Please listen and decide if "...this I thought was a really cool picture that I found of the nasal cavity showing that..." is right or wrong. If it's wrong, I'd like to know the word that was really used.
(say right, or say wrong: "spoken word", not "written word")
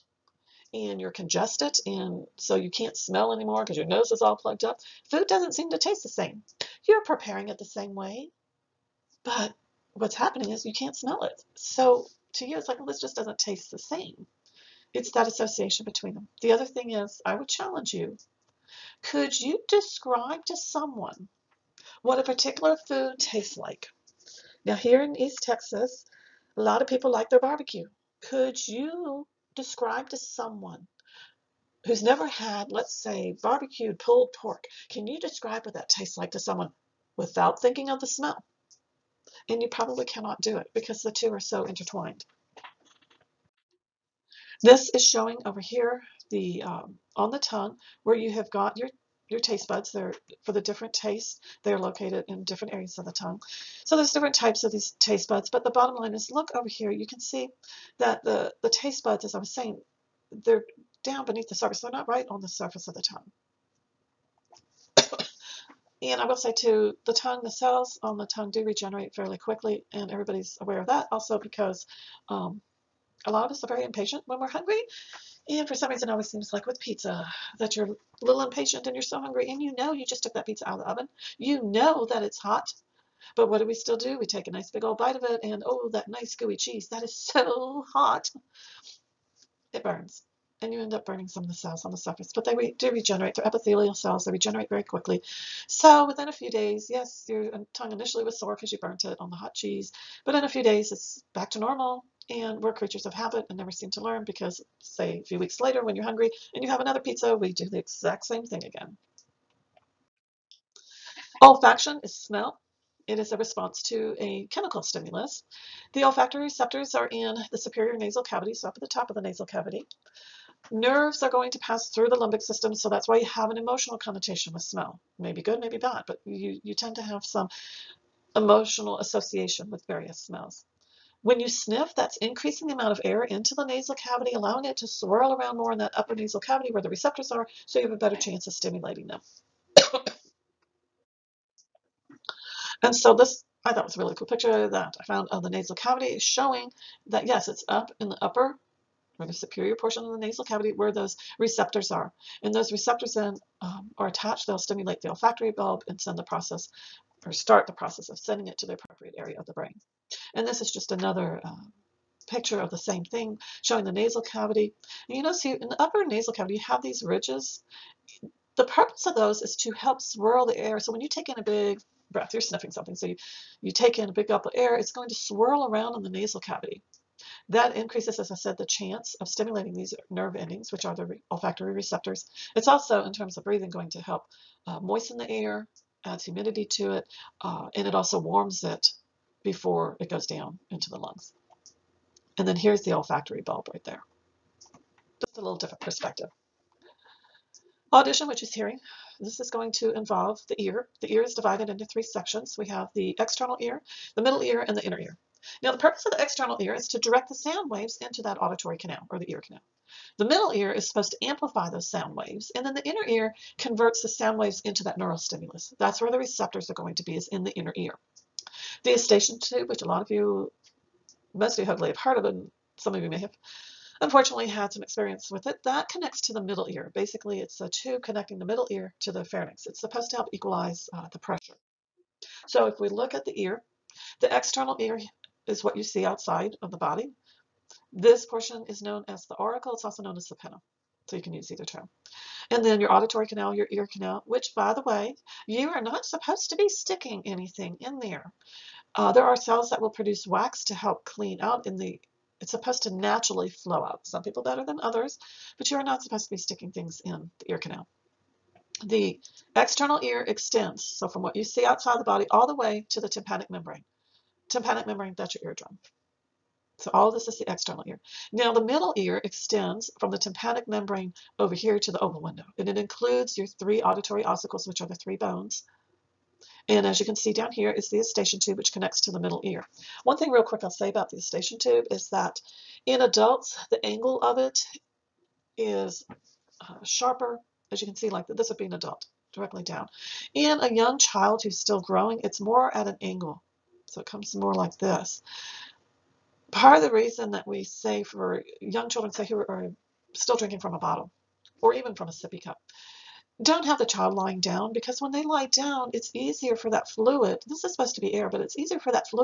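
right.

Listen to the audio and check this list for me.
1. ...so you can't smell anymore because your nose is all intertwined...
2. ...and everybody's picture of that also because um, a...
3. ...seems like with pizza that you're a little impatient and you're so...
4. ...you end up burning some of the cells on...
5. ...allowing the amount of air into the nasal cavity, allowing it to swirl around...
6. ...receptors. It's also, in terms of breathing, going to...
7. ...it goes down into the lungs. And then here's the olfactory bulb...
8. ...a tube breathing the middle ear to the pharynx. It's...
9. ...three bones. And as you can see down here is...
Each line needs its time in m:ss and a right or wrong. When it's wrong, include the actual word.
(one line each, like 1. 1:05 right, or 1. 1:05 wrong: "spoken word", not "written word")
1. 0:02 wrong: "plugged", not "intertwined"
2. 1:09 wrong: "aware", not "picture"
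3. 1:16 right
4. 1:30 right
5. 2:12 wrong: "increasing", not "allowing"
6. 3:01 right
7. 3:10 right
8. 3:47 wrong: "connecting", not "breathing"
9. 4:34 right.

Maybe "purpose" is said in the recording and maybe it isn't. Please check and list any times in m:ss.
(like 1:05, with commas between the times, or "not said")
2:48, 3:25.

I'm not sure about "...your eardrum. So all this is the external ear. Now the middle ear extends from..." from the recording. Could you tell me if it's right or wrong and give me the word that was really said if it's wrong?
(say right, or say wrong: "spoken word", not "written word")
right.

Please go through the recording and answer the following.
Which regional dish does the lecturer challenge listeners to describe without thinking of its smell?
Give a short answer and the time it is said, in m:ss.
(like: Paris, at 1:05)
Barbecued pulled pork, at 0:33.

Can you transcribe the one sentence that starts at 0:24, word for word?
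Now, here in East Texas, a lot of people like their barbecue.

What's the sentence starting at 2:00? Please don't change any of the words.
Nerves are going to pass through the limbic system, so that's why you have an emotional connotation with smell.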